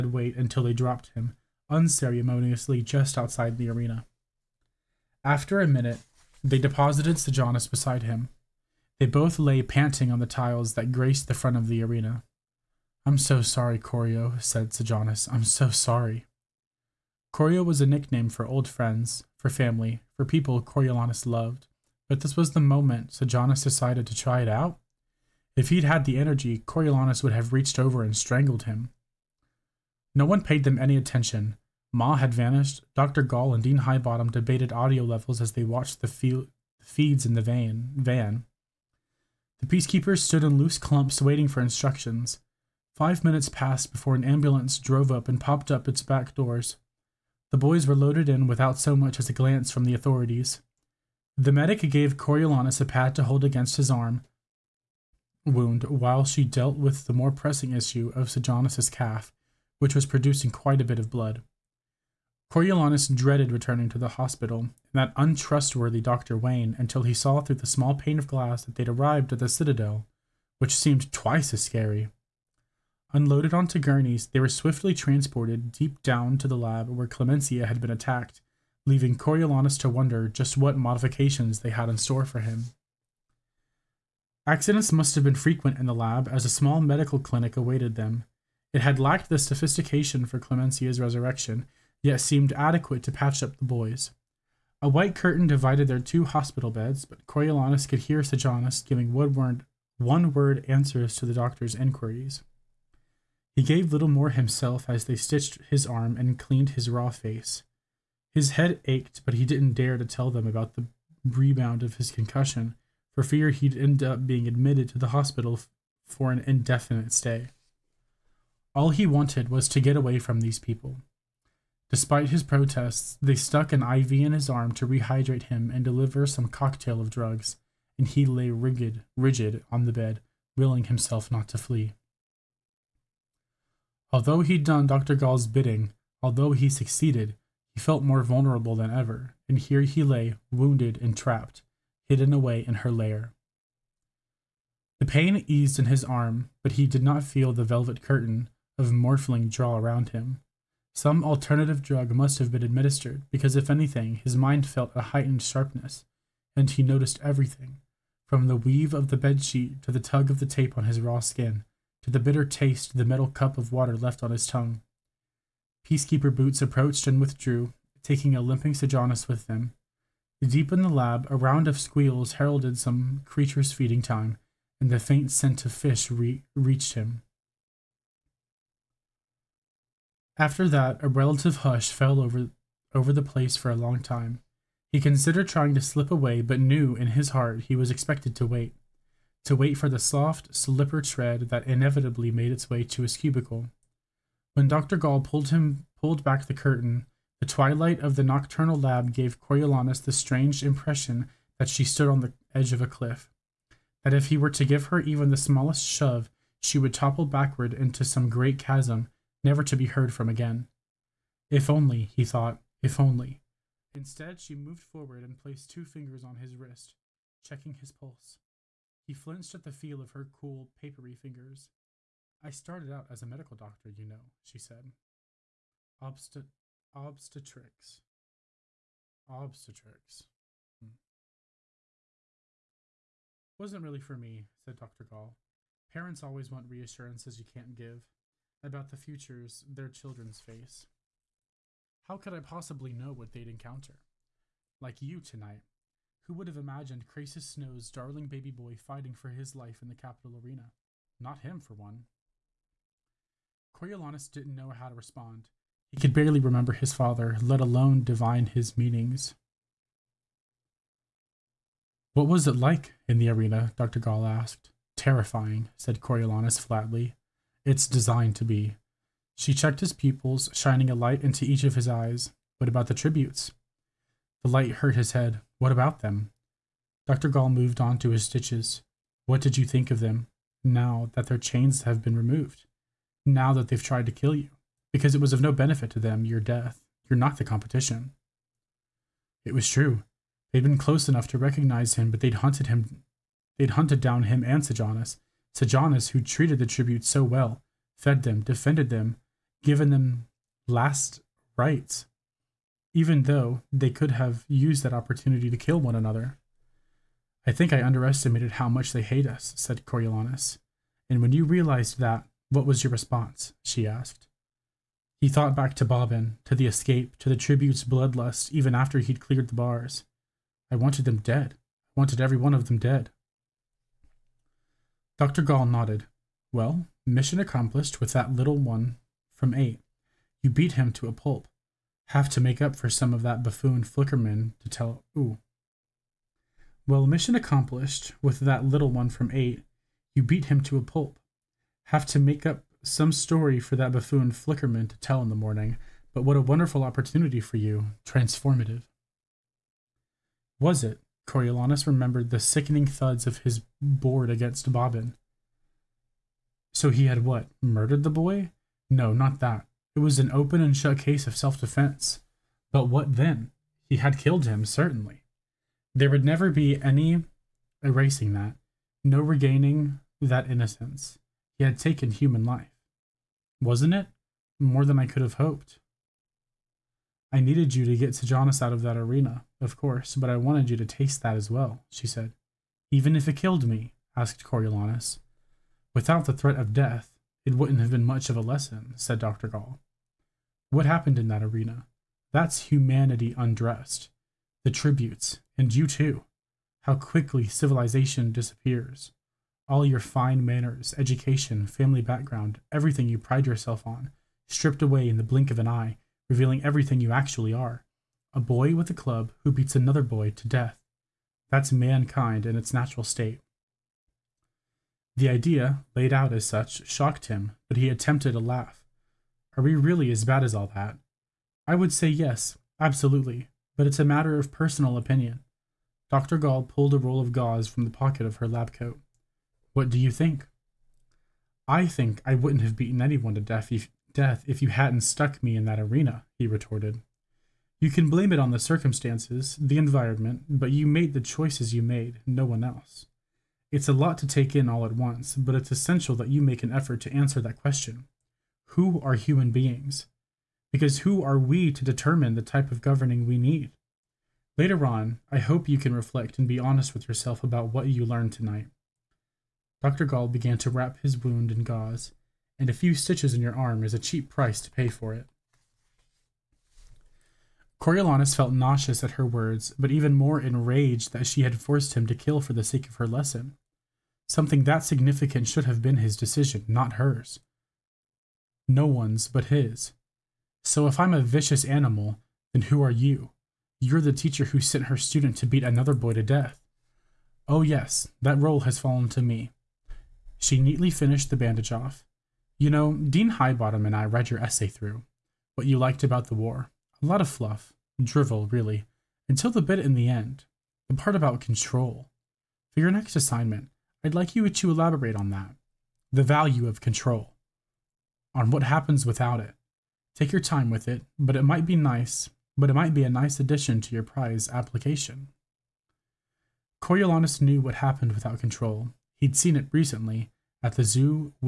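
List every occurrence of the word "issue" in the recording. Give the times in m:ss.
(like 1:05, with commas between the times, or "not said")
0:57.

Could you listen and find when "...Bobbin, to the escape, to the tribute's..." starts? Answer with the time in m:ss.
5:15.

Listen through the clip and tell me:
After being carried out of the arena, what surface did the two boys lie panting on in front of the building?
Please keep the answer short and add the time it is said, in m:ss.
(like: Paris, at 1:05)
Tiles, at 0:10.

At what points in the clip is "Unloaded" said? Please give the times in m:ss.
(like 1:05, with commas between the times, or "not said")
1:13.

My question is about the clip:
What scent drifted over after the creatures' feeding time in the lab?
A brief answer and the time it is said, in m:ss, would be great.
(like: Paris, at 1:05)
Fish, at 2:55.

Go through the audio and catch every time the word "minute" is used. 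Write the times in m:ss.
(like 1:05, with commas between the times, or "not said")
0:05, 0:43.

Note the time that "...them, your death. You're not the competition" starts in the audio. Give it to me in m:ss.
4:45.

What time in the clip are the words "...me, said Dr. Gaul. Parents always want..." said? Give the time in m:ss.
3:54.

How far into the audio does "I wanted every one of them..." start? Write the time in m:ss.
5:21.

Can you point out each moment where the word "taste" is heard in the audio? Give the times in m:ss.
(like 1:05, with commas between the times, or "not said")
2:42, 6:20.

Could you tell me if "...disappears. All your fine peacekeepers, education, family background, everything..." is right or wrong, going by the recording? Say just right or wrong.
wrong.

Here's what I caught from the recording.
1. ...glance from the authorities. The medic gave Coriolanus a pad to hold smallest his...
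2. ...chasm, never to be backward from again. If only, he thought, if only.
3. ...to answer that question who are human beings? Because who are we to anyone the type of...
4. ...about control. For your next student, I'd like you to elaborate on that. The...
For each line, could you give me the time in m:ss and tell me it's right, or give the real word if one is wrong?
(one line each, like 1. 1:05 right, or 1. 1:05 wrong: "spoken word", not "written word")
1. 0:49 wrong: "against", not "smallest"
2. 3:28 wrong: "heard", not "backward"
3. 7:27 wrong: "determine", not "anyone"
4. 8:21 wrong: "assignment", not "student".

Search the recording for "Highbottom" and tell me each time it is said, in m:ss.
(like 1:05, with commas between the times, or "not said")
0:33, 8:13.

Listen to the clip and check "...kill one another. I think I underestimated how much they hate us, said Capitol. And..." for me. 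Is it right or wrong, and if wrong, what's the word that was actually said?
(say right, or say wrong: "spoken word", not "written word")
wrong: "Coriolanus", not "Capitol".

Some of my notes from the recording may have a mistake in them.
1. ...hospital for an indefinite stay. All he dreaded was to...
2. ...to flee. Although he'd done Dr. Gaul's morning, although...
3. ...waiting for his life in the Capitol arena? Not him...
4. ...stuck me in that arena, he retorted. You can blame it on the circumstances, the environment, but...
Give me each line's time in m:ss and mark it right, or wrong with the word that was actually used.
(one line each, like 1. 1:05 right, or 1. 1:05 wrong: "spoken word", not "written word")
1. 1:55 wrong: "wanted", not "dreaded"
2. 2:11 wrong: "bidding", not "morning"
3. 4:08 wrong: "fighting", not "waiting"
4. 7:15 right.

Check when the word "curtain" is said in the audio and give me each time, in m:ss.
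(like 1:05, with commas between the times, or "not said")
1:35, 2:28, 3:16.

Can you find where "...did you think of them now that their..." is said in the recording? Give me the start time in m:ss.
4:39.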